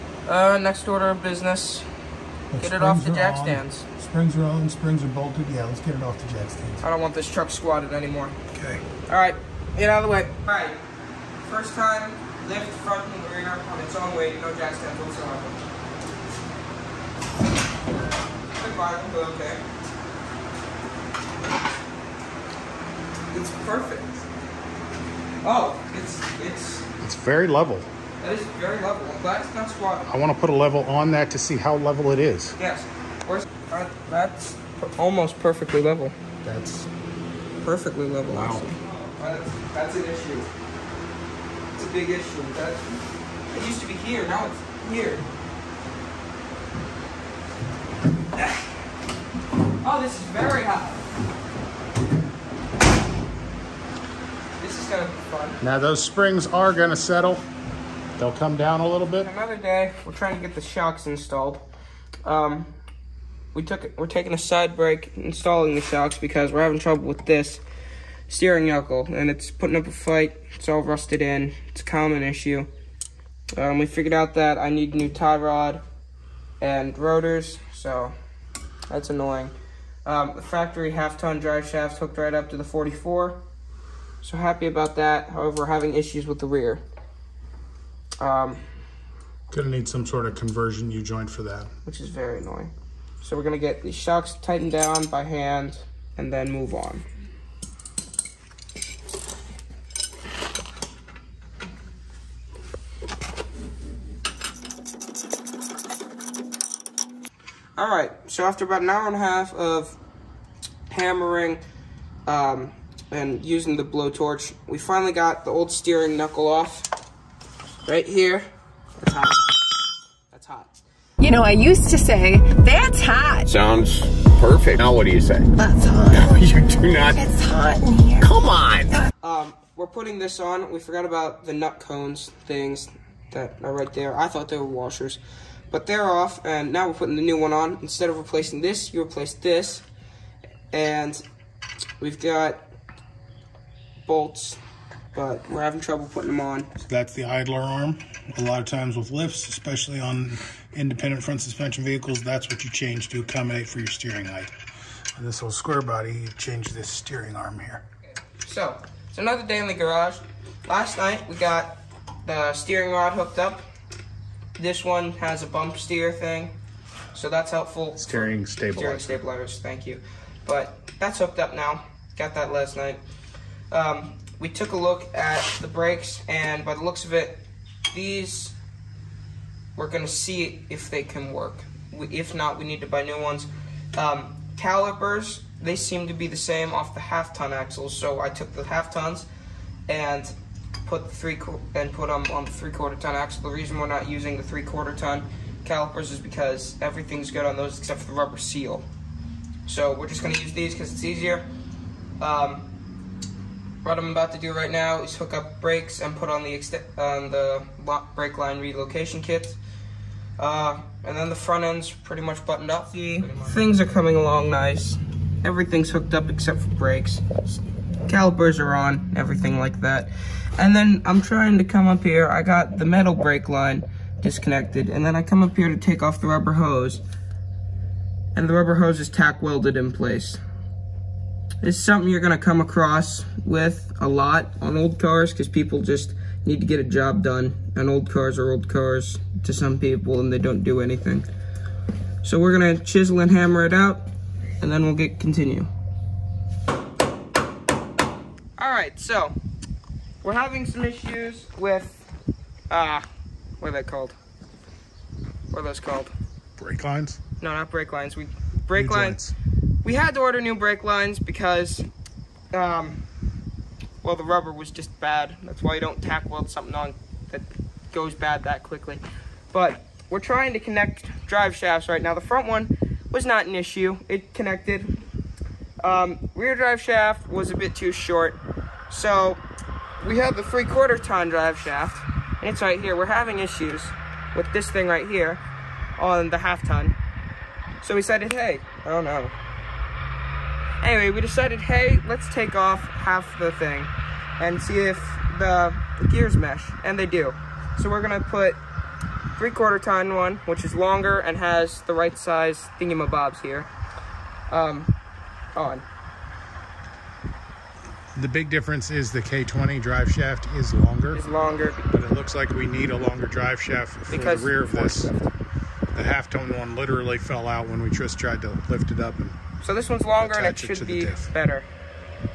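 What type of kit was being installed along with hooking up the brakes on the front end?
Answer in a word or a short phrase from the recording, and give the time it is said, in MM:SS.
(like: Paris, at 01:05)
brake line relocation kit, at 03:28.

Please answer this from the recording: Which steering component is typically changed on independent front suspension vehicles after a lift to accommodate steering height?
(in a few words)
idler arm.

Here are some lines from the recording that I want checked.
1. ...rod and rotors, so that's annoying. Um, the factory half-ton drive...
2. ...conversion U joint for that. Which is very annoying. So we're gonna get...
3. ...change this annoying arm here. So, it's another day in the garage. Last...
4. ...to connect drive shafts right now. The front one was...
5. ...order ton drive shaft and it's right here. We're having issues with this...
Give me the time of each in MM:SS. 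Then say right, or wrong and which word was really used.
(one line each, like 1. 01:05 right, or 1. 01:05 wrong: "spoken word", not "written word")
1. 01:15 right
2. 01:30 right
3. 02:36 wrong: "steering", not "annoying"
4. 04:30 right
5. 04:40 wrong: "quarter", not "order".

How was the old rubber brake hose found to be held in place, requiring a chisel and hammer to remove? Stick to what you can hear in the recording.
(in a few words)
tack welded.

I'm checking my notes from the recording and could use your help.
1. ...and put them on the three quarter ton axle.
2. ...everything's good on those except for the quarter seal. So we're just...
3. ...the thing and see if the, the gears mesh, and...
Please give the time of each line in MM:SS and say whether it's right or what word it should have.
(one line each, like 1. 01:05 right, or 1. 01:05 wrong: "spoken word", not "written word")
1. 03:11 right
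2. 03:16 wrong: "rubber", not "quarter"
3. 04:53 right.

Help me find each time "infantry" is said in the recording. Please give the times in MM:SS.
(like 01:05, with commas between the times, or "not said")
not said.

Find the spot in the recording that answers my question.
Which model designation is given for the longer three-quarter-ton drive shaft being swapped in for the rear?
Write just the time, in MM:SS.
05:09.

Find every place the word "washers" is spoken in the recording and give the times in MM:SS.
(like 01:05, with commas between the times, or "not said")
02:14.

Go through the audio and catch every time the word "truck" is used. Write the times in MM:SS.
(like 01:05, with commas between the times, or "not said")
00:07.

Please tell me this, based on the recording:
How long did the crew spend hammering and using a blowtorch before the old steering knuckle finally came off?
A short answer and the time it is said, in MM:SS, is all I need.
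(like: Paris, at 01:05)
an hour and a half, at 01:48.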